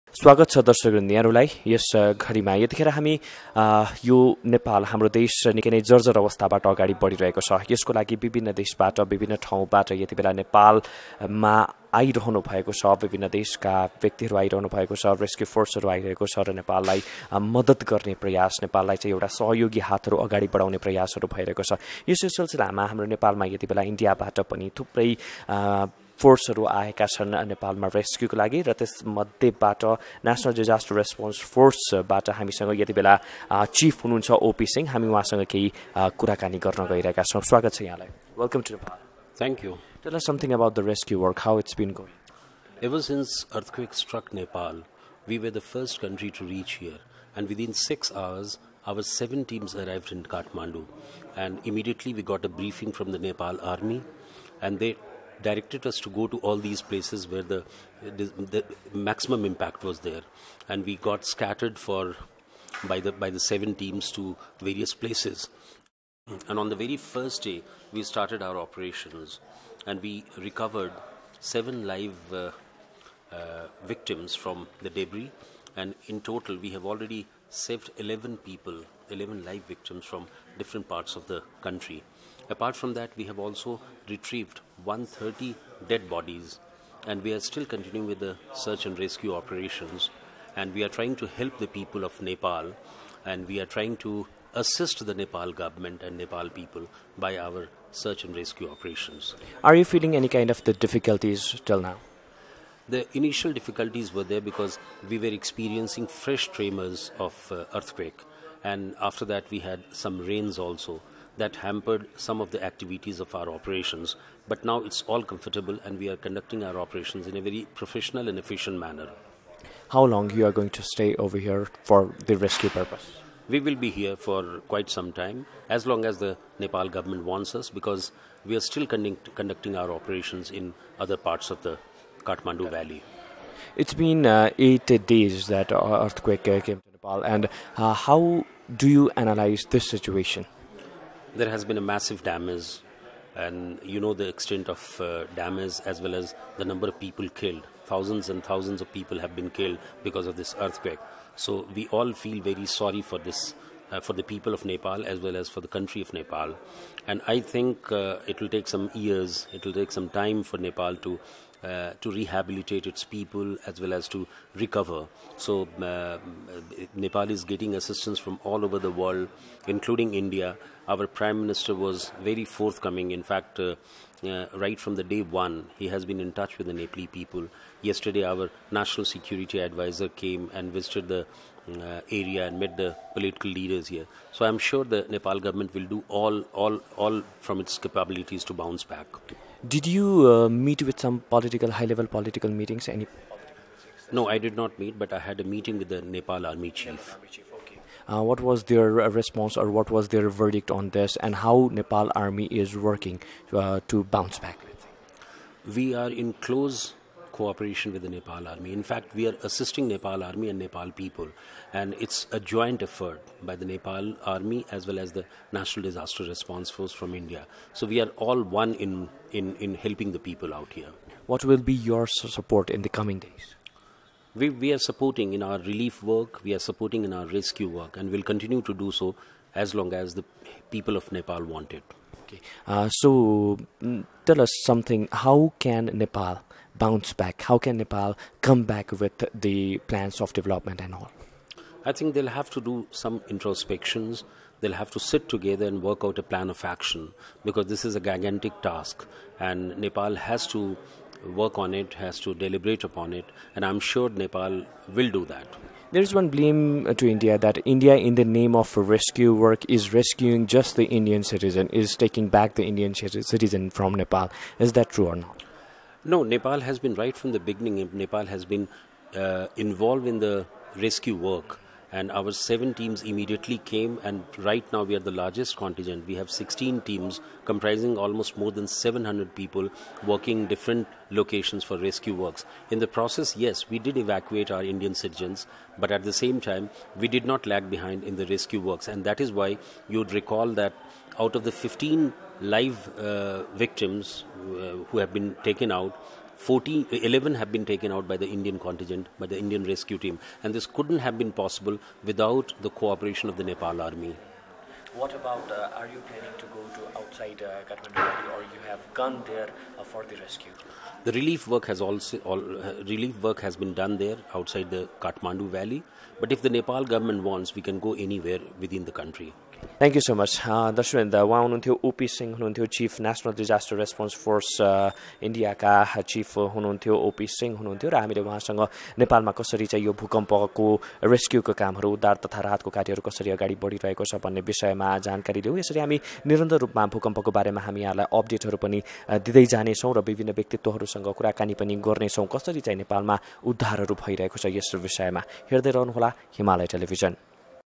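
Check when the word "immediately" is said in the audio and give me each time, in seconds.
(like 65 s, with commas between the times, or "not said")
51 s, 273 s.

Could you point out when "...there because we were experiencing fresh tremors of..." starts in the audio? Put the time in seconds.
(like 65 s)
104 s.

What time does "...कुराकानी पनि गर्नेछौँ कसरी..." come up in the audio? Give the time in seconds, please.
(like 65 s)
341 s.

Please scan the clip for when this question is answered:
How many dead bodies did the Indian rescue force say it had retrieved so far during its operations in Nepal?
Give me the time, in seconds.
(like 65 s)
84 s.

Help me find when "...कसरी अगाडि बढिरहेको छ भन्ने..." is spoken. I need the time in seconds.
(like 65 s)
333 s.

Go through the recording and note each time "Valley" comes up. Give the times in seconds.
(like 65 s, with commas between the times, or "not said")
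132 s, 315 s.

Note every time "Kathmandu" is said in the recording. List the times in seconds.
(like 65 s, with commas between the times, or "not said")
50 s, 132 s, 307 s, 314 s.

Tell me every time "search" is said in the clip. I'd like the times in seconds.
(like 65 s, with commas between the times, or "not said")
88 s, 97 s.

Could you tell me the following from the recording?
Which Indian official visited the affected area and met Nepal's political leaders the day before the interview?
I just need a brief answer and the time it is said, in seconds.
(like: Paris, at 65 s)
National Security Advisor, at 178 s.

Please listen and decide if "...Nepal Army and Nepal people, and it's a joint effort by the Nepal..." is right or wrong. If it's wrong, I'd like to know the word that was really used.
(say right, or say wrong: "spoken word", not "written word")
right.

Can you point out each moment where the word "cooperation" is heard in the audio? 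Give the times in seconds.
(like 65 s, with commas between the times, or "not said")
207 s, 302 s.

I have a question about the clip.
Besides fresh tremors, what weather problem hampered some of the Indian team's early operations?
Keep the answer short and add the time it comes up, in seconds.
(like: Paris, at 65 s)
Rains, at 110 s.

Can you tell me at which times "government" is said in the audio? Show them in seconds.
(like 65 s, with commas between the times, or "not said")
95 s, 126 s, 185 s, 316 s.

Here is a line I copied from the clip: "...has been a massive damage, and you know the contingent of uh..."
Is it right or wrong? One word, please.
wrong.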